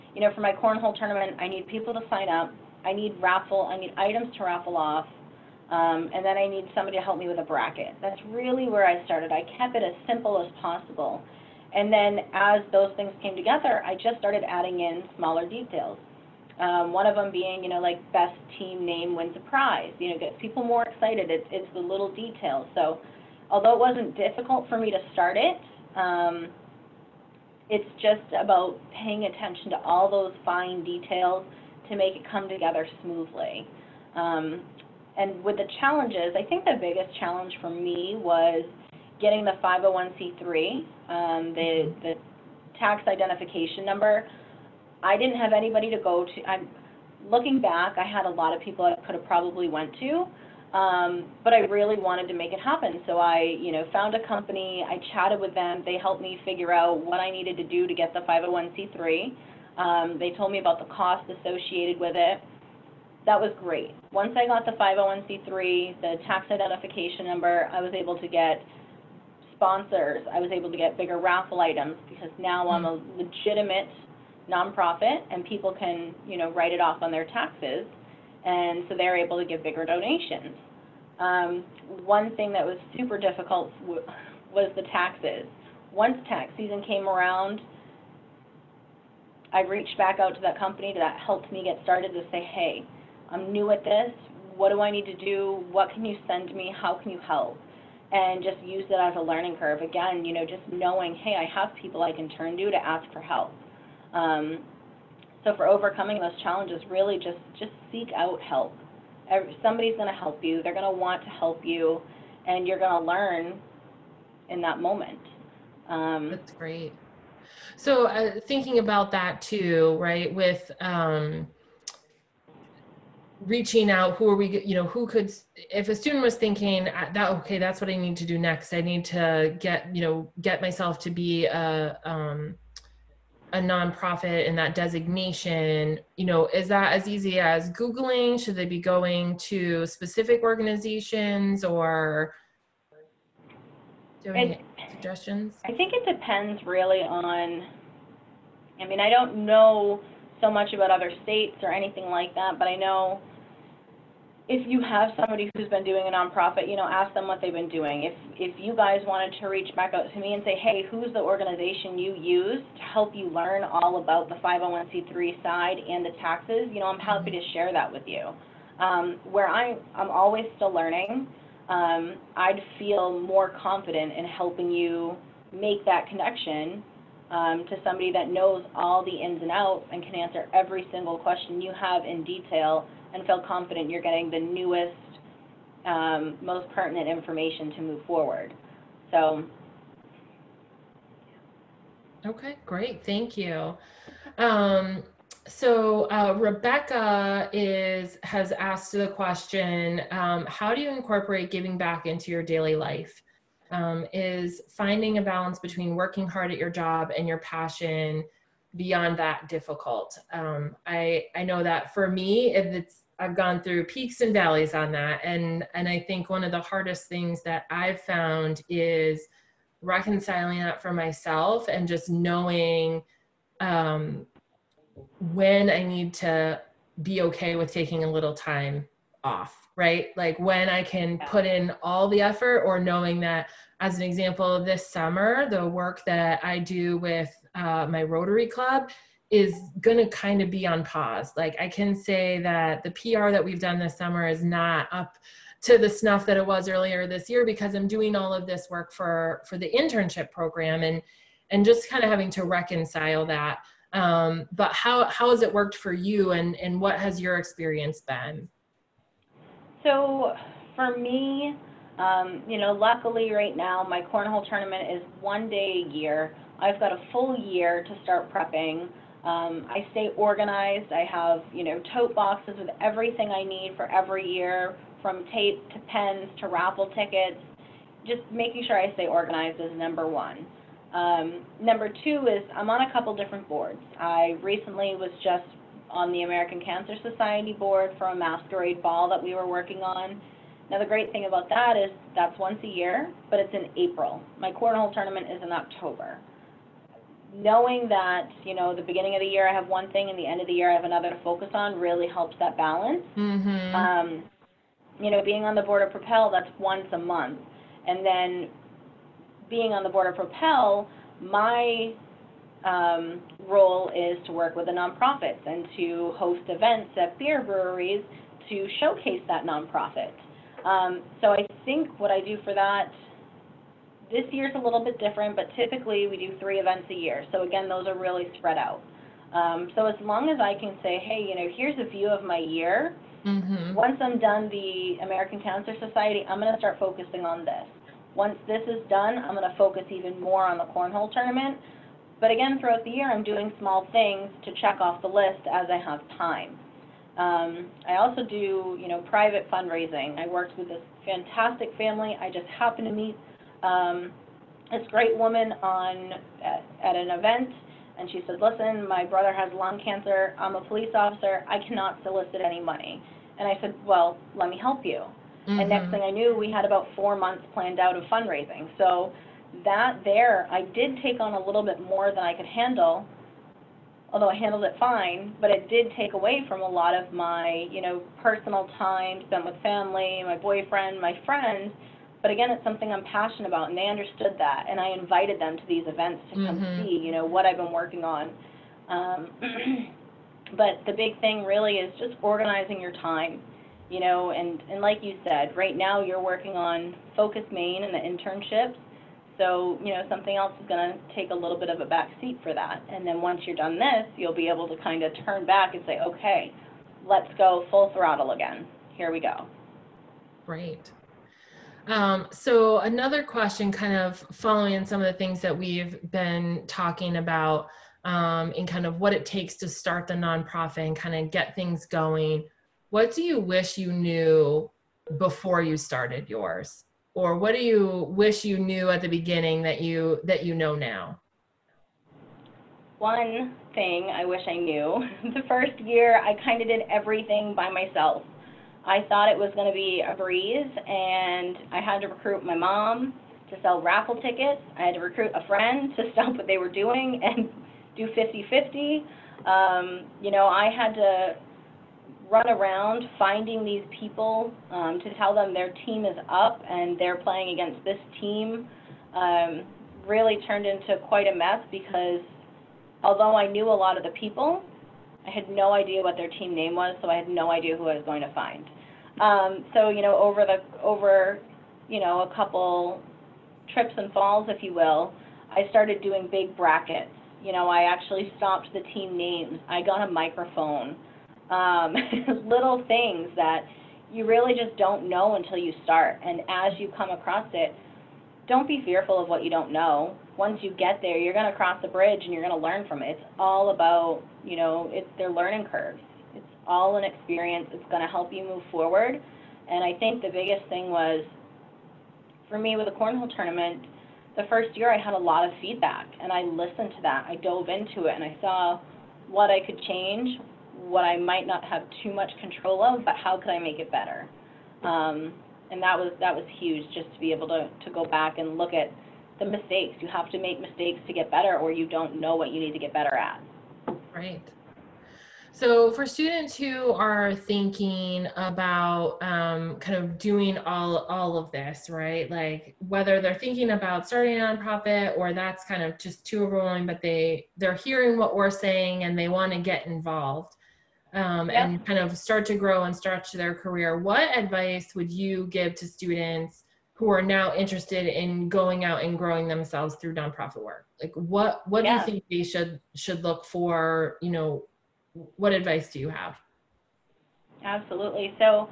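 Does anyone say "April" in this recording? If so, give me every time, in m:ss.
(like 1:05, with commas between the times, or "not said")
4:53.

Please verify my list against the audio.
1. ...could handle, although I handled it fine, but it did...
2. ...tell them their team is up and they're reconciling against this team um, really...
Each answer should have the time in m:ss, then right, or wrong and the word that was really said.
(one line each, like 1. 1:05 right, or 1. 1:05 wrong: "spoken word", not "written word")
1. 6:12 right
2. 7:35 wrong: "playing", not "reconciling".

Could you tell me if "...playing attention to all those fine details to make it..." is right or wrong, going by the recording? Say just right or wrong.
wrong.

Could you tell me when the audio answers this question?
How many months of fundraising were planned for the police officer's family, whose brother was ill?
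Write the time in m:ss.
6:06.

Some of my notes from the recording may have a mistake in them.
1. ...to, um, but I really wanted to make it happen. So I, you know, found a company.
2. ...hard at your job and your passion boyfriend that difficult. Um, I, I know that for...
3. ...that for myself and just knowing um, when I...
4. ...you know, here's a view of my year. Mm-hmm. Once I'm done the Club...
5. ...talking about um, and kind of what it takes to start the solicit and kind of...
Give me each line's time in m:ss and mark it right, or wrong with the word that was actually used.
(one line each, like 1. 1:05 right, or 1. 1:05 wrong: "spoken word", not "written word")
1. 0:50 right
2. 3:26 wrong: "beyond", not "boyfriend"
3. 3:40 right
4. 5:31 wrong: "American", not "Club"
5. 6:56 wrong: "nonprofit", not "solicit".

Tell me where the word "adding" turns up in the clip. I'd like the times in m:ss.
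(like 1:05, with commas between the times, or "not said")
0:14.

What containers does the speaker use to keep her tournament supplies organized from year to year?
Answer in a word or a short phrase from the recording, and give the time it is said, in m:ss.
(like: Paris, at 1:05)
Tote boxes, at 4:31.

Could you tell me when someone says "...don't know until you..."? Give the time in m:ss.
8:04.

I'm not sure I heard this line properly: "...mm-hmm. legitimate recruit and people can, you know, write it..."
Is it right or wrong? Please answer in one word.
wrong.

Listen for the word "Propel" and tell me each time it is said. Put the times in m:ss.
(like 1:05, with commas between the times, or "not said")
5:05, 5:10.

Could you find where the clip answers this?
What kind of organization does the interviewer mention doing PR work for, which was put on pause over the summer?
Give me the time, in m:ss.
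3:57.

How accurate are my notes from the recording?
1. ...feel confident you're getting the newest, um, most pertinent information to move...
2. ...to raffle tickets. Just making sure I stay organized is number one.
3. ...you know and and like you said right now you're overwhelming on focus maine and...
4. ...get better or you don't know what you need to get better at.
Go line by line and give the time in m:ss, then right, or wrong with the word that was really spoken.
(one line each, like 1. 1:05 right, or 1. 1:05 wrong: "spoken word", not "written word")
1. 3:03 right
2. 4:36 right
3. 6:33 wrong: "working", not "overwhelming"
4. 8:41 right.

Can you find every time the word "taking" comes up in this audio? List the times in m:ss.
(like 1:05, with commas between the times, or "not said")
3:47.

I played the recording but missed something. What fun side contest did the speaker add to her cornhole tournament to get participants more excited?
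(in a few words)
Best team name.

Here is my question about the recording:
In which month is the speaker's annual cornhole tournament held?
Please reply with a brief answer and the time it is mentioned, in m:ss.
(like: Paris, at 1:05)
October, at 4:55.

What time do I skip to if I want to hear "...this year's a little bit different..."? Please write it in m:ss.
5:24.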